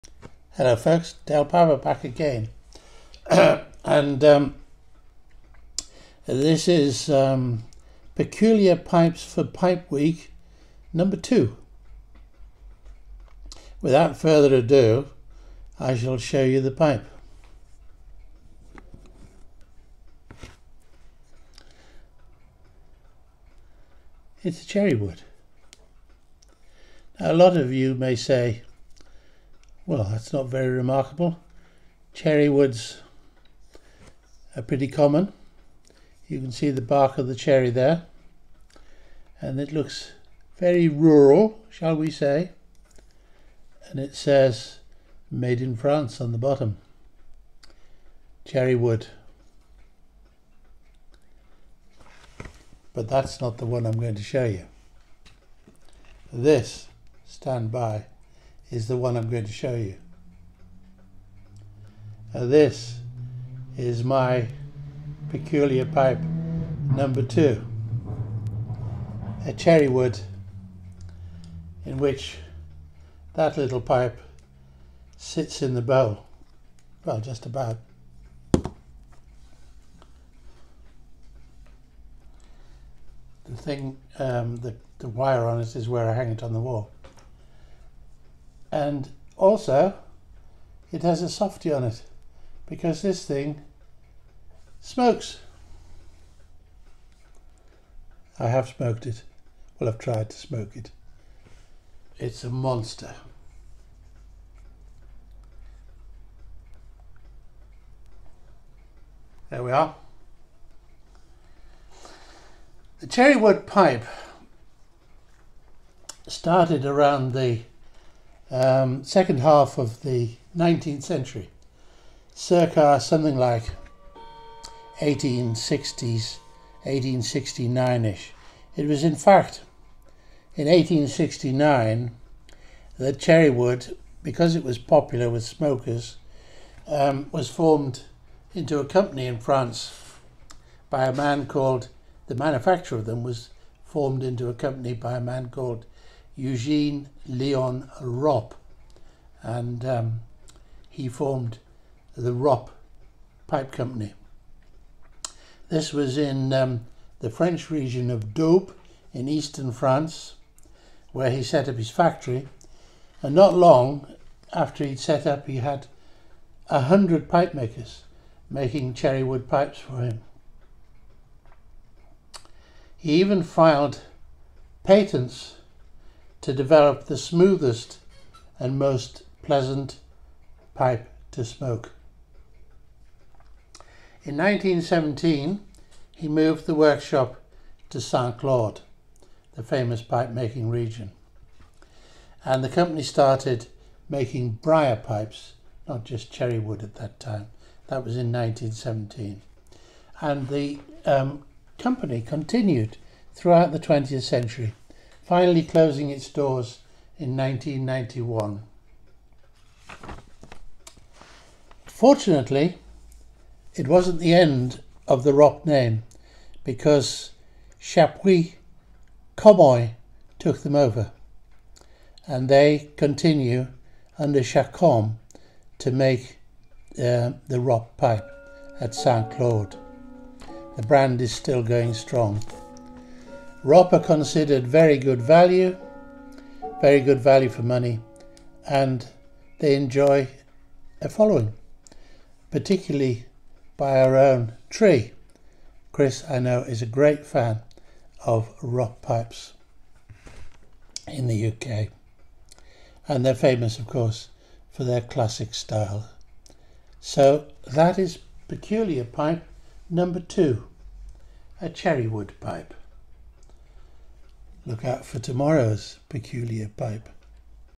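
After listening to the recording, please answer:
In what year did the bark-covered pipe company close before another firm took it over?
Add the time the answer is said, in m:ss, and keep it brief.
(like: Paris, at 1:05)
1991, at 3:27.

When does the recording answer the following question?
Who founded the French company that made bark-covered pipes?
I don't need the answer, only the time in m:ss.
2:26.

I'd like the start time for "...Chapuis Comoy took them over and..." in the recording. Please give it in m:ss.
3:37.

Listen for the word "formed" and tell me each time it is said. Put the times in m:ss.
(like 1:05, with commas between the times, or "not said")
2:17, 2:23, 2:31.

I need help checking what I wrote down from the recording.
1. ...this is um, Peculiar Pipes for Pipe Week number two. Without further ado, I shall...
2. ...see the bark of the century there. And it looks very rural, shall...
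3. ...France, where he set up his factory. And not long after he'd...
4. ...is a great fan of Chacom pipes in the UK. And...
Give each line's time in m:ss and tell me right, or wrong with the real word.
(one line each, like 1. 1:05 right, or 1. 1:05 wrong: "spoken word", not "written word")
1. 0:06 right
2. 0:36 wrong: "cherry", not "century"
3. 2:39 right
4. 4:06 wrong: "Ropp", not "Chacom".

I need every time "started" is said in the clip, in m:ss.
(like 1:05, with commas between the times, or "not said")
1:56, 3:13.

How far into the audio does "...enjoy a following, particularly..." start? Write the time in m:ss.
3:59.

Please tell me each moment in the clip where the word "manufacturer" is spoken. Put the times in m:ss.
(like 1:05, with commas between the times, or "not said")
2:22.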